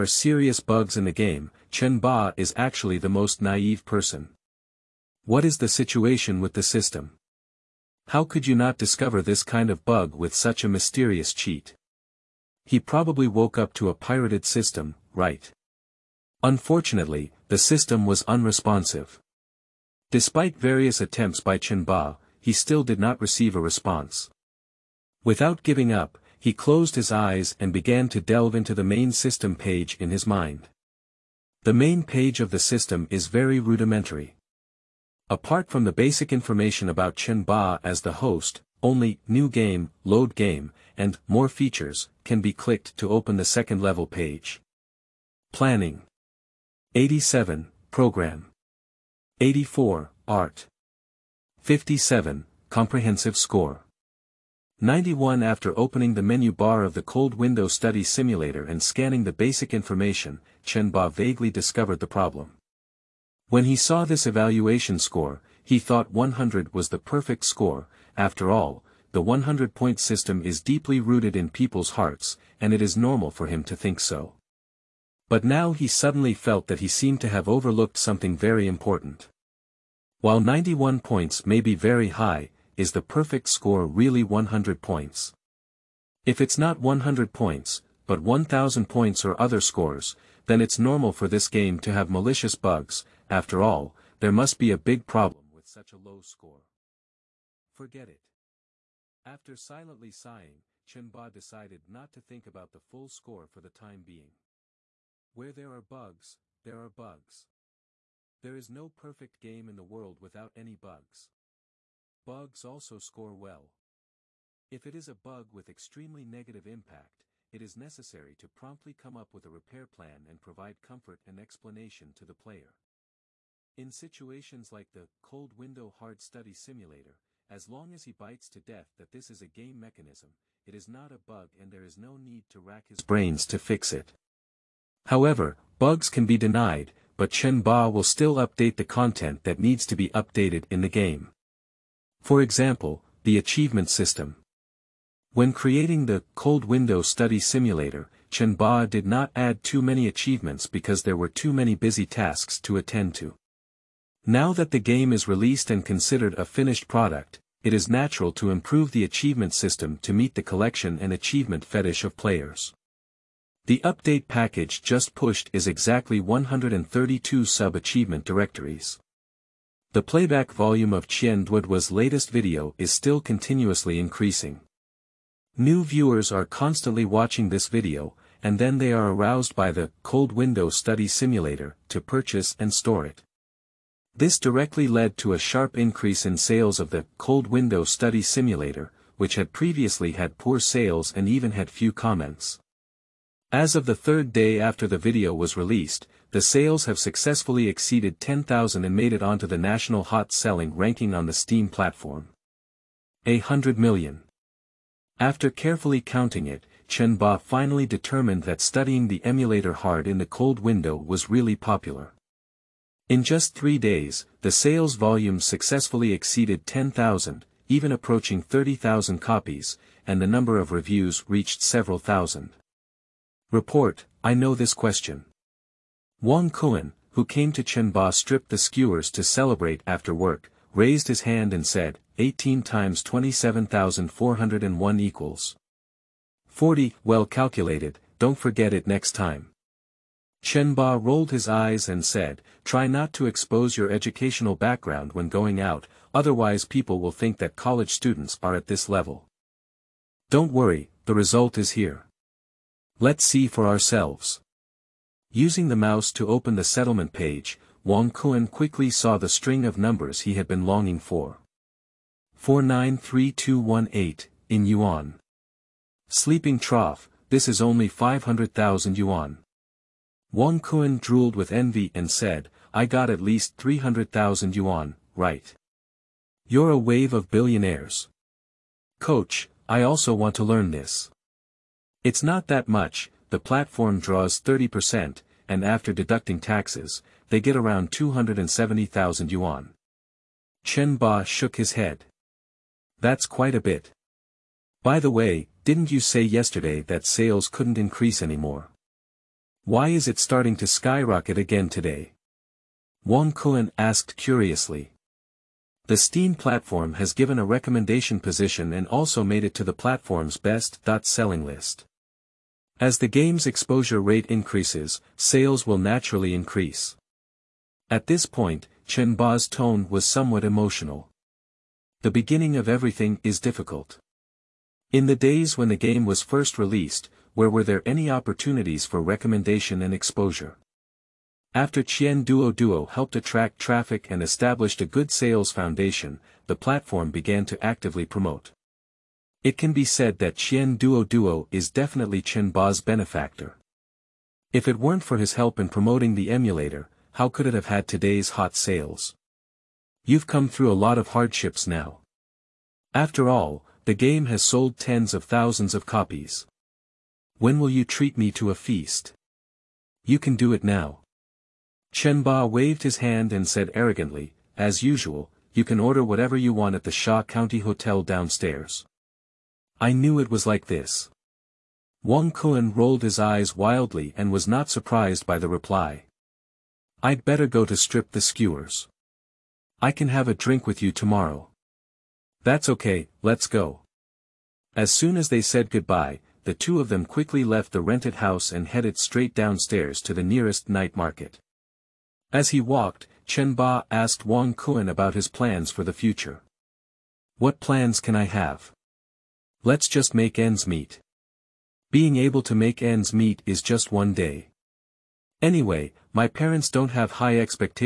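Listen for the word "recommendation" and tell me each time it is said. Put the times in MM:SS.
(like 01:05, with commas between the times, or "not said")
05:07, 05:28.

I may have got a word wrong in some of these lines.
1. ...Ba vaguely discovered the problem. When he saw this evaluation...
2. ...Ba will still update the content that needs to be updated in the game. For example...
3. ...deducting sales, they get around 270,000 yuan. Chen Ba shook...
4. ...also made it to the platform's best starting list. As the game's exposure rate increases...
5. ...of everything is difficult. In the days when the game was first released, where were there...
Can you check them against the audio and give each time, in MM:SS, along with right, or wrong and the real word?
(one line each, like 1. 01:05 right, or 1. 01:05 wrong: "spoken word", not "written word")
1. 01:00 right
2. 02:17 right
3. 04:45 wrong: "taxes", not "sales"
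4. 05:08 wrong: "selling", not "starting"
5. 05:22 right.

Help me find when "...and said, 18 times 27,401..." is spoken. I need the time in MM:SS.
03:51.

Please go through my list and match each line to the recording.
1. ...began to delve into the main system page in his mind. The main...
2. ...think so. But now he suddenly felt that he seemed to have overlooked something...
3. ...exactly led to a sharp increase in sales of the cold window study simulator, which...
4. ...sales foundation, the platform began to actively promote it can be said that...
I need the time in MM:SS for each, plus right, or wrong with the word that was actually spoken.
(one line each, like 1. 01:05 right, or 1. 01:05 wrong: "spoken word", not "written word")
1. 00:27 right
2. 01:13 right
3. 03:04 wrong: "directly", not "exactly"
4. 05:35 right.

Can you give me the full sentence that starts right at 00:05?
What is the situation with the system?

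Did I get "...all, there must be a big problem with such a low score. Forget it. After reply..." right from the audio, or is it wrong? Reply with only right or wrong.
wrong.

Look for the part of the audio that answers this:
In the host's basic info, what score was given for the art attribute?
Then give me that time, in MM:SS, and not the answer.
00:50.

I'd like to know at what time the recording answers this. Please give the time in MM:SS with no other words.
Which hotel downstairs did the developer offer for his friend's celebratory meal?
06:06.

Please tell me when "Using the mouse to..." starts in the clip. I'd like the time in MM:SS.
04:15.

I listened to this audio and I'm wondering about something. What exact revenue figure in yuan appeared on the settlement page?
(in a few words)
493218.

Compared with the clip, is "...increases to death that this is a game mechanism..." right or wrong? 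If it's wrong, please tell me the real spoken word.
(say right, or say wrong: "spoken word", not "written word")
wrong: "bites", not "increases".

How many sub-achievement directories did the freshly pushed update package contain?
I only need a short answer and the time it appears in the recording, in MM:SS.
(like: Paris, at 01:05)
132, at 02:46.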